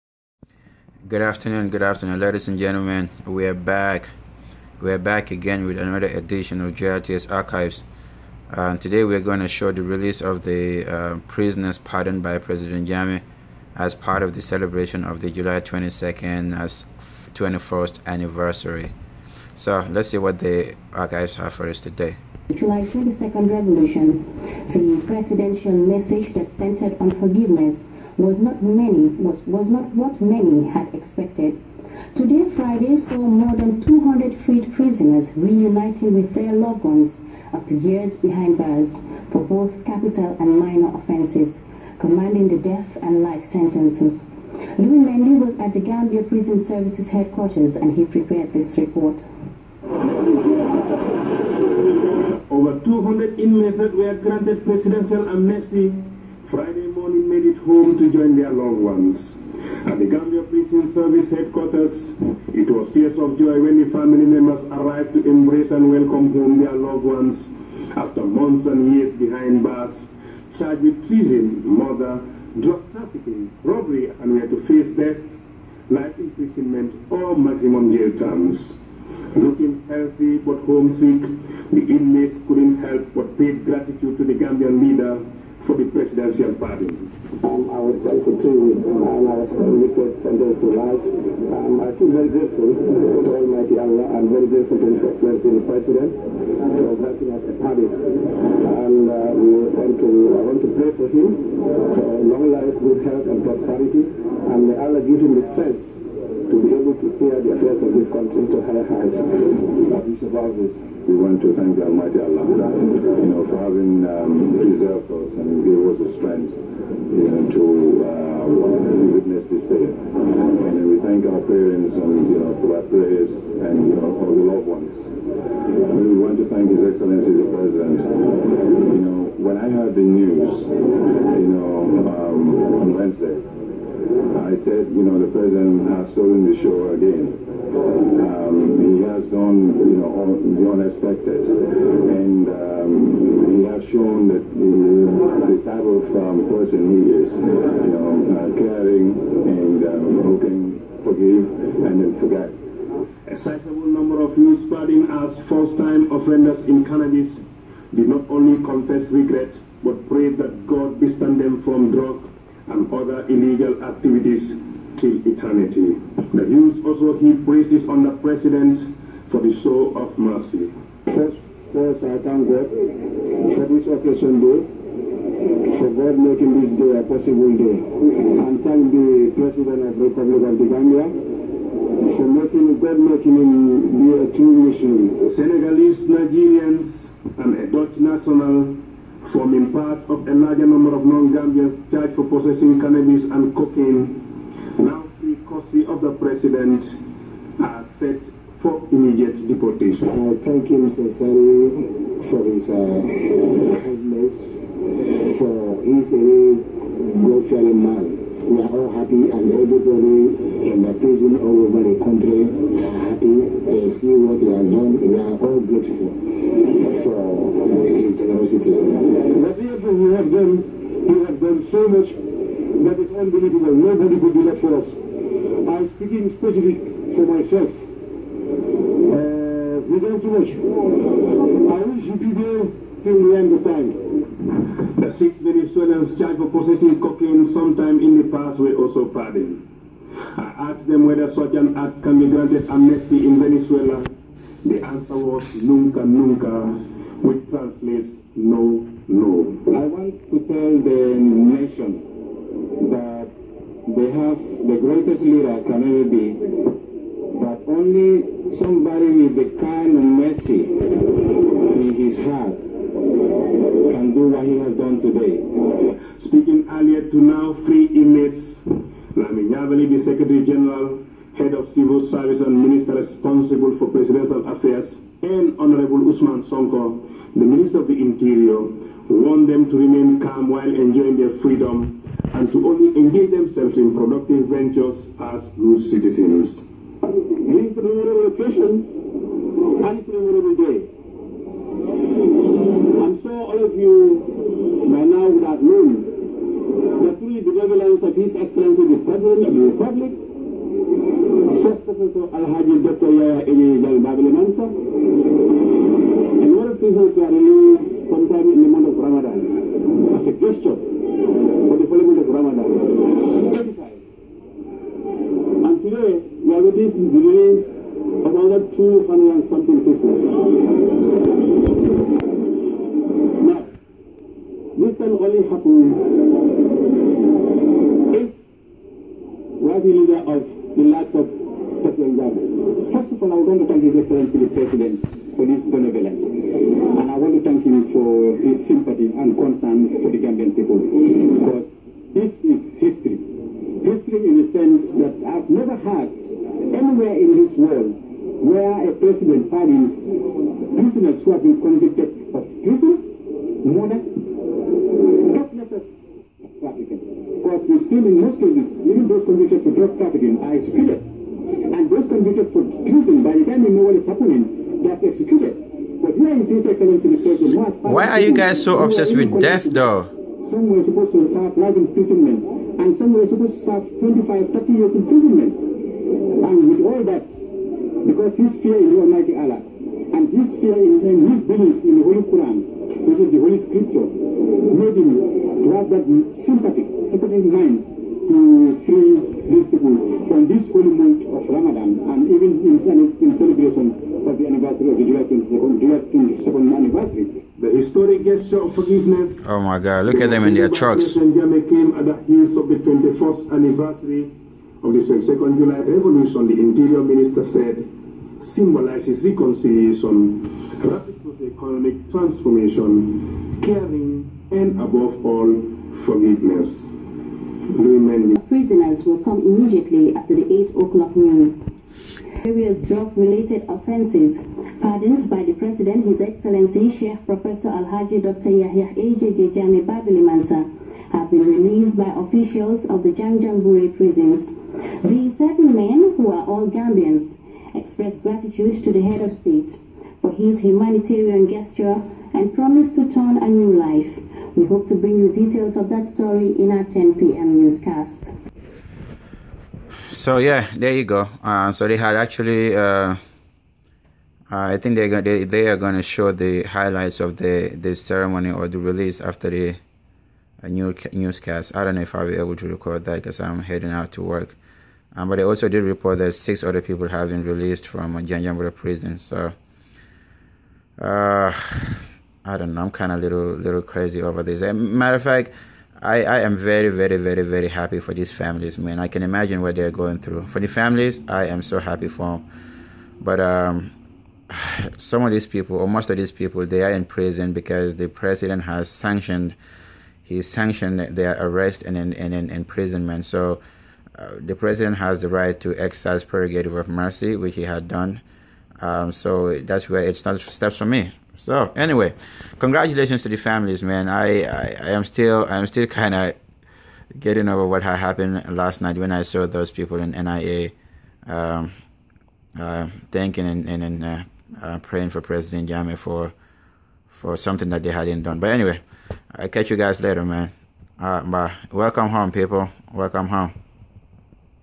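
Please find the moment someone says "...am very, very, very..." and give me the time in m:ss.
7:56.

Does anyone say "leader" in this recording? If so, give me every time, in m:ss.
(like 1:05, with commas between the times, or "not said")
1:24, 4:15, 5:29.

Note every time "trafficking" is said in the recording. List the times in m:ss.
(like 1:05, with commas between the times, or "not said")
1:12, 5:59.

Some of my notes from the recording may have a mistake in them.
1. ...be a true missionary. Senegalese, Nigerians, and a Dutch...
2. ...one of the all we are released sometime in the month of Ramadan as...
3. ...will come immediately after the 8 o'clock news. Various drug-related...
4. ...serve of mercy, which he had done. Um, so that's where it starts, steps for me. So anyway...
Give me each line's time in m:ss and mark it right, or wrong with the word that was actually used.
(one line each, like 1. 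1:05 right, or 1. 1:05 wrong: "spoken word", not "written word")
1. 3:03 right
2. 5:06 right
3. 6:59 right
4. 8:16 wrong: "prerogative", not "serve".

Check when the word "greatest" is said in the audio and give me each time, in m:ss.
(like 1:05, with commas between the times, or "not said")
4:14.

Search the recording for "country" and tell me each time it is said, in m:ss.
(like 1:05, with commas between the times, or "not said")
1:48, 3:32.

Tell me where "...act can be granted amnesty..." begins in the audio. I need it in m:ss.
4:01.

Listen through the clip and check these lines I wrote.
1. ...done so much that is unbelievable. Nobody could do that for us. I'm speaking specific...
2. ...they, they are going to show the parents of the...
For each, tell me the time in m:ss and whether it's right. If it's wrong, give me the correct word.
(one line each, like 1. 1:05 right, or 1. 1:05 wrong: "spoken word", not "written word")
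1. 3:41 right
2. 7:35 wrong: "highlights", not "parents".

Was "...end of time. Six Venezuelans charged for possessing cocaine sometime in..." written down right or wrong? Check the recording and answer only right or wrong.
right.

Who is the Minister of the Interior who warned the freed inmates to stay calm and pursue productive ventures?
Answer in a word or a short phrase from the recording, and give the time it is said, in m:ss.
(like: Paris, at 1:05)
Ousman Sonko, at 4:35.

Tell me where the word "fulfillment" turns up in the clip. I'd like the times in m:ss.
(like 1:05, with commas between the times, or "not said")
5:11.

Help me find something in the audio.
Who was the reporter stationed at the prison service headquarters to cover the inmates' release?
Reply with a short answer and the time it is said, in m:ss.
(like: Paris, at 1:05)
Louis Mendy, at 0:44.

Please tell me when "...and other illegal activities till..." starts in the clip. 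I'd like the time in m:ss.
2:42.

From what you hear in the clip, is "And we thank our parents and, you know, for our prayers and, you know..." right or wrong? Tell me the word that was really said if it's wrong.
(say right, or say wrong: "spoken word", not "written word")
right.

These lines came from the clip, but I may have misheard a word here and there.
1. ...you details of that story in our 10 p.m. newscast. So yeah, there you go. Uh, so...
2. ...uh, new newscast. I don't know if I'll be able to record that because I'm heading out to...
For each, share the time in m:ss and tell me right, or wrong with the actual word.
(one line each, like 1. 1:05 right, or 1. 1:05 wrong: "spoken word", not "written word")
1. 7:25 right
2. 7:40 right.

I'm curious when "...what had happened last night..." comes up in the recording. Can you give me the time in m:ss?
8:27.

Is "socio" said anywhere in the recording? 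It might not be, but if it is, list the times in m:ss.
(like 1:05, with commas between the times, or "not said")
6:51.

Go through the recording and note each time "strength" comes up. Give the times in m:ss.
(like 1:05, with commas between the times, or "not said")
1:45, 1:56.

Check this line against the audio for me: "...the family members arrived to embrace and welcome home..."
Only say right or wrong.
right.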